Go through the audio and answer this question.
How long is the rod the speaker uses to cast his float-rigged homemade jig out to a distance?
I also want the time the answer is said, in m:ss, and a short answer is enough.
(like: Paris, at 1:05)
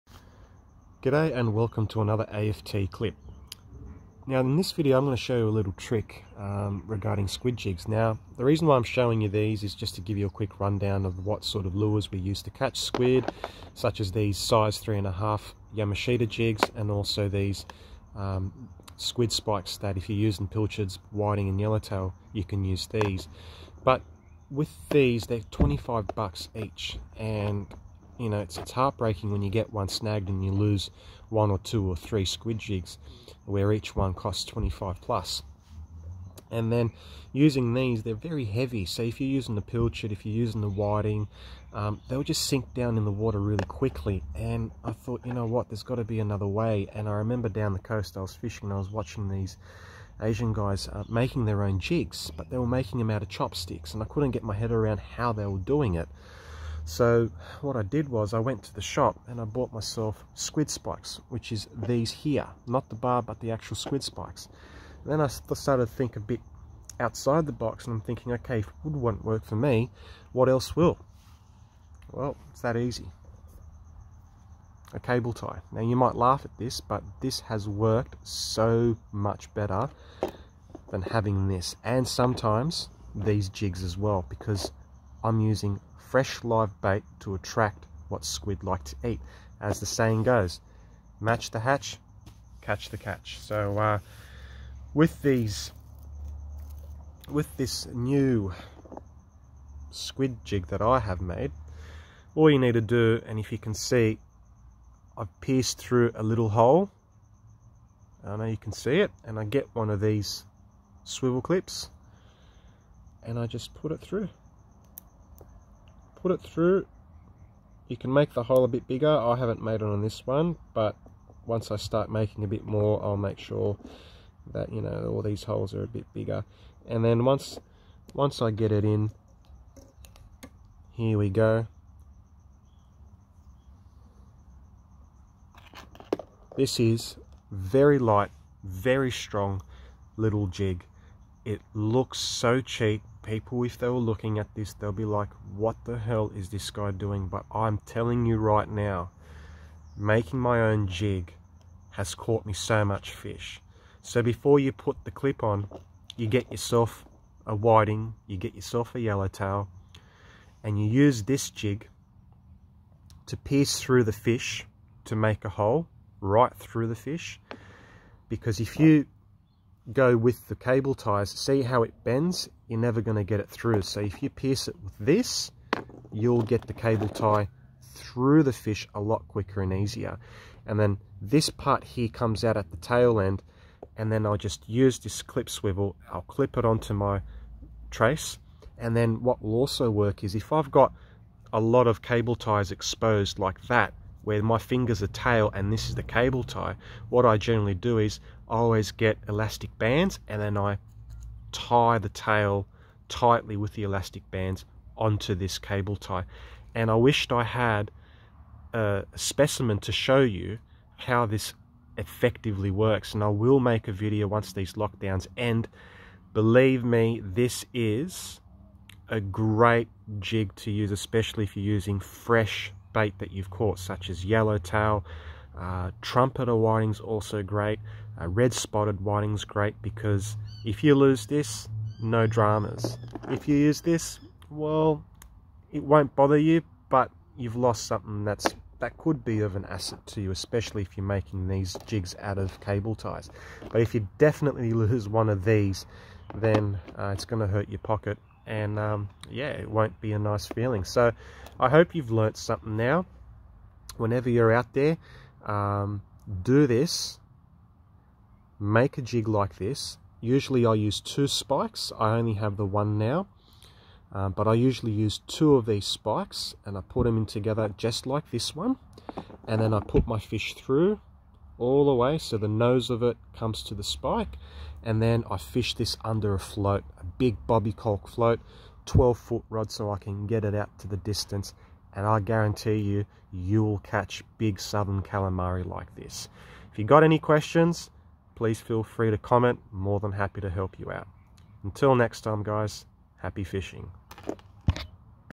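12 foot, at 4:38.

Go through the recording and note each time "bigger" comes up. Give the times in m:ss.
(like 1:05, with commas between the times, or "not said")
1:58, 2:06.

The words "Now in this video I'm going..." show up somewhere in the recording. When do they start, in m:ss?
0:04.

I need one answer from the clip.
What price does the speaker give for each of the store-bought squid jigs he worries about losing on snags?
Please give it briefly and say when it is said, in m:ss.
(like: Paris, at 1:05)
$25, at 0:25.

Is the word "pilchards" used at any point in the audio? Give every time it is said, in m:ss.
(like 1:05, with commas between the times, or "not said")
0:20, 0:39.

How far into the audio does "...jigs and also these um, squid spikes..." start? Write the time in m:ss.
0:16.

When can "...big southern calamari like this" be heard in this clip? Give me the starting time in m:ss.
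4:44.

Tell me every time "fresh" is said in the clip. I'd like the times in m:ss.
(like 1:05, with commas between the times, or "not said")
1:25, 3:41.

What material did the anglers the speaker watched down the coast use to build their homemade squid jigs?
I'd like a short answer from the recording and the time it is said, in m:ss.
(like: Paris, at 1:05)
Chopsticks, at 0:53.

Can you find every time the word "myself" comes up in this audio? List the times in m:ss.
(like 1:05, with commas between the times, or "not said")
0:59.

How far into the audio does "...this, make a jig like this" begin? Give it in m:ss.
4:16.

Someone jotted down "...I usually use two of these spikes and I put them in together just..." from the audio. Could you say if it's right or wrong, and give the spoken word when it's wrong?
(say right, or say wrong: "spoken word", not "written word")
right.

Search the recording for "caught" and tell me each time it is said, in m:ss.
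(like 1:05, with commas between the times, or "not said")
2:32, 3:43.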